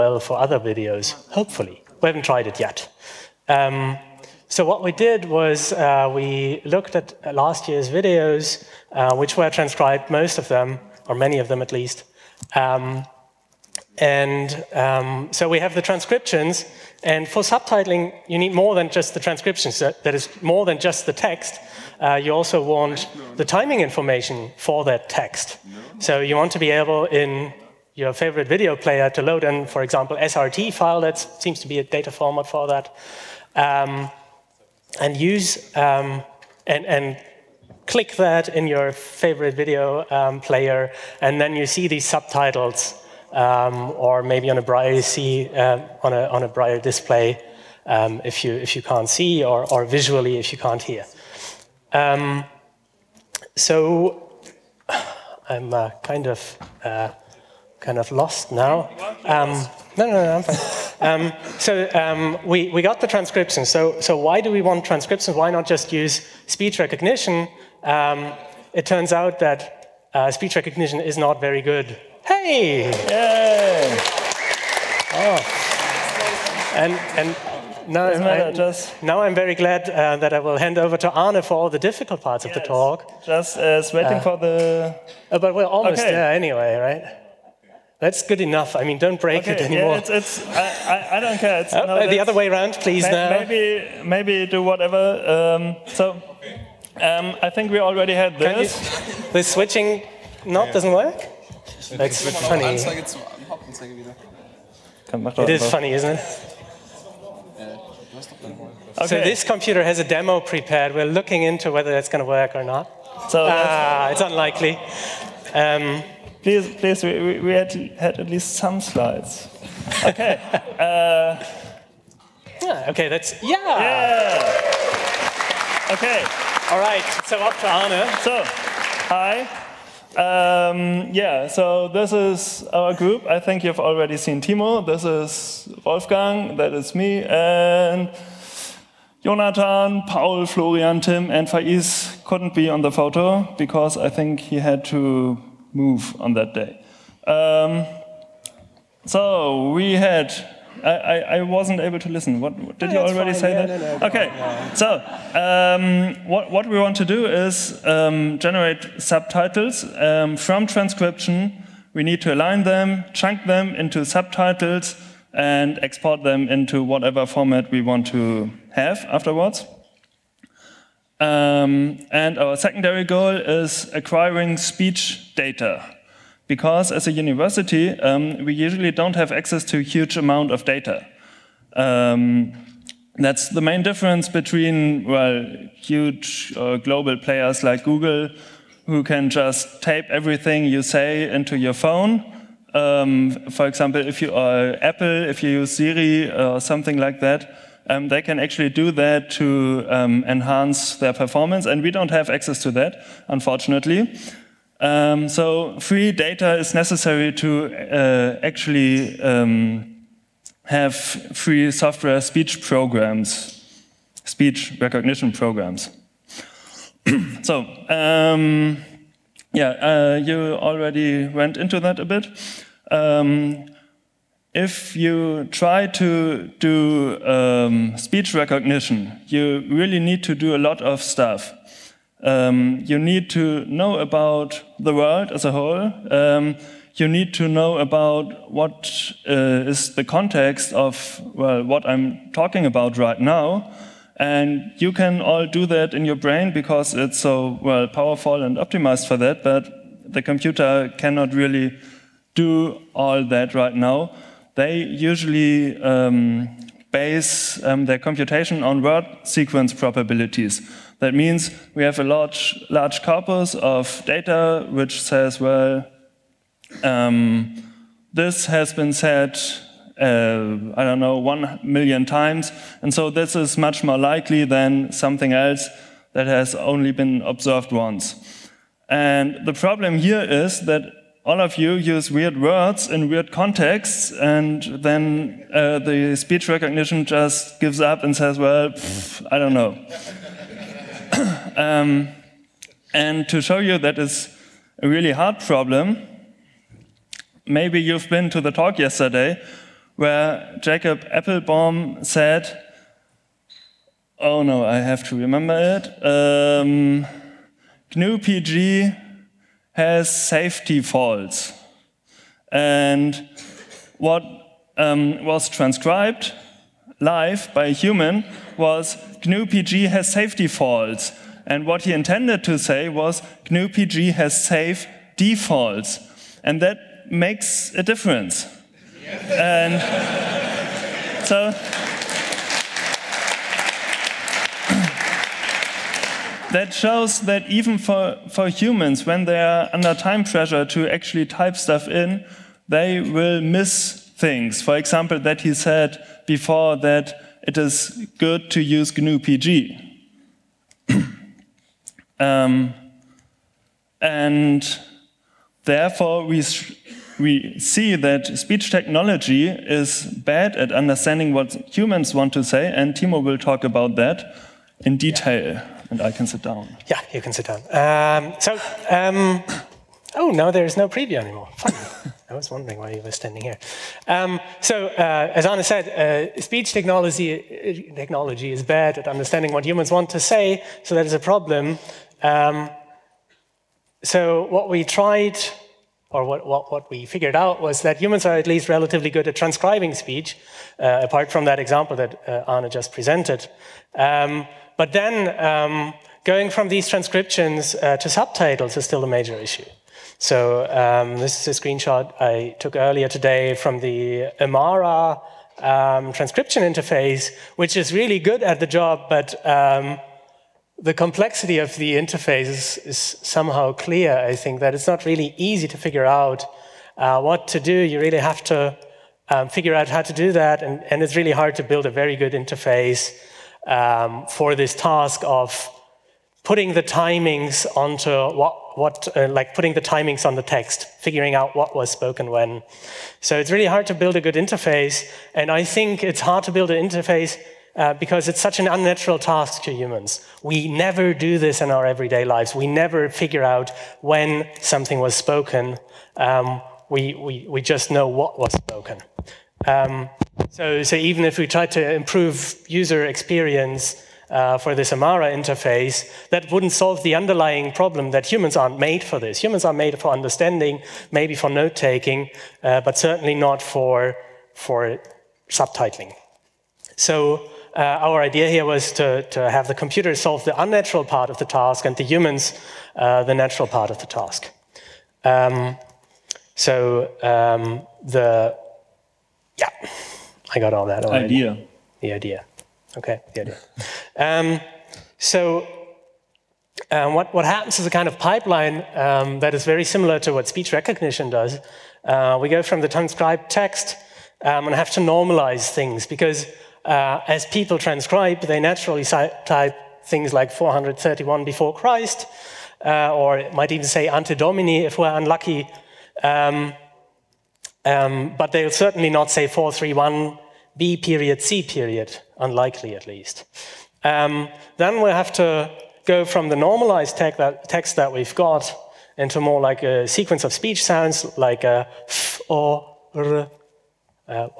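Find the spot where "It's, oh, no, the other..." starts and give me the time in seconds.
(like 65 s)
91 s.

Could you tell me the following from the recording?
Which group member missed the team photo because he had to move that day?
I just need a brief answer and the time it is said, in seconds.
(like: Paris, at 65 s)
Faiz, at 141 s.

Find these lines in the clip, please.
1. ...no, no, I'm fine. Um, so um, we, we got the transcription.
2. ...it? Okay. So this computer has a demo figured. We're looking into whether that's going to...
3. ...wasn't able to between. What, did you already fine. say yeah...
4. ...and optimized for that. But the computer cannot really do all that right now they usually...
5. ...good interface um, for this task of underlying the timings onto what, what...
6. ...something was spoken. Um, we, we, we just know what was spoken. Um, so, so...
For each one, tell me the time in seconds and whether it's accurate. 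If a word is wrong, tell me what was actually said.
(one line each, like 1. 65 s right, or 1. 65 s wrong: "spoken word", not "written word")
1. 60 s right
2. 106 s wrong: "prepared", not "figured"
3. 151 s wrong: "listen", not "between"
4. 248 s right
5. 422 s wrong: "putting", not "underlying"
6. 444 s right.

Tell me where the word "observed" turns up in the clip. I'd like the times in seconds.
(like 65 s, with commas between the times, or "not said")
277 s.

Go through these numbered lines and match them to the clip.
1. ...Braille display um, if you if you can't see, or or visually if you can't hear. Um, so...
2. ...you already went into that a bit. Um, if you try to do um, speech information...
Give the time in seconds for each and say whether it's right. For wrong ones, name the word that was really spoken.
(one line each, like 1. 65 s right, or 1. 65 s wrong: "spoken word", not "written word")
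1. 46 s right
2. 220 s wrong: "recognition", not "information".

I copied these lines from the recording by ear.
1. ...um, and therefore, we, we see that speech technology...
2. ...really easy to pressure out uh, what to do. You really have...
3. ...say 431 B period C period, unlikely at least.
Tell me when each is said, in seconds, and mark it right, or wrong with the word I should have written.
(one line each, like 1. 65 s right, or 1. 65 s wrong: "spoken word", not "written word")
1. 352 s right
2. 415 s wrong: "figure", not "pressure"
3. 509 s right.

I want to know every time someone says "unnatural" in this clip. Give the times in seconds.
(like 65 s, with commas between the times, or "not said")
438 s, 470 s.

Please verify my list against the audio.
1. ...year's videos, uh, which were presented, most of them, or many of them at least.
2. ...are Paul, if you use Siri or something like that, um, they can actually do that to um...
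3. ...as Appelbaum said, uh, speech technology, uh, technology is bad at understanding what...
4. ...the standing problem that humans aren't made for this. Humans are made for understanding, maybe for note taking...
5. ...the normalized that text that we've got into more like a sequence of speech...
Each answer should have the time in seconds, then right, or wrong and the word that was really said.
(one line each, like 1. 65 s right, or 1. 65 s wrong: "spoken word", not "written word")
1. 7 s wrong: "transcribed", not "presented"
2. 194 s wrong: "Apple", not "Paul"
3. 375 s wrong: "Arne", not "Appelbaum"
4. 457 s wrong: "underlying", not "standing"
5. 516 s right.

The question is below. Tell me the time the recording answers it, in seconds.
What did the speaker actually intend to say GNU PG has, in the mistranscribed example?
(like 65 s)
324 s.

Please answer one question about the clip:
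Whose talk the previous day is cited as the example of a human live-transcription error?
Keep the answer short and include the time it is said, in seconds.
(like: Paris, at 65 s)
Jacob Appelbaum, at 300 s.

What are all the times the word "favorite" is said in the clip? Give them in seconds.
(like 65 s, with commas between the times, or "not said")
28 s, 38 s.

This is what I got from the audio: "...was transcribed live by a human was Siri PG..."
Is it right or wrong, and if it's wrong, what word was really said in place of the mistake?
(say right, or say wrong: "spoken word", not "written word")
wrong: "GNU", not "Siri".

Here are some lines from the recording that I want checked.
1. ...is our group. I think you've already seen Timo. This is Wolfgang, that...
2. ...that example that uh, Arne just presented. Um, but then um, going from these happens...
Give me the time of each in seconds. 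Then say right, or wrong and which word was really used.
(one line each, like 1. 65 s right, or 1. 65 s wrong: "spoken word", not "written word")
1. 132 s right
2. 391 s wrong: "transcriptions", not "happens".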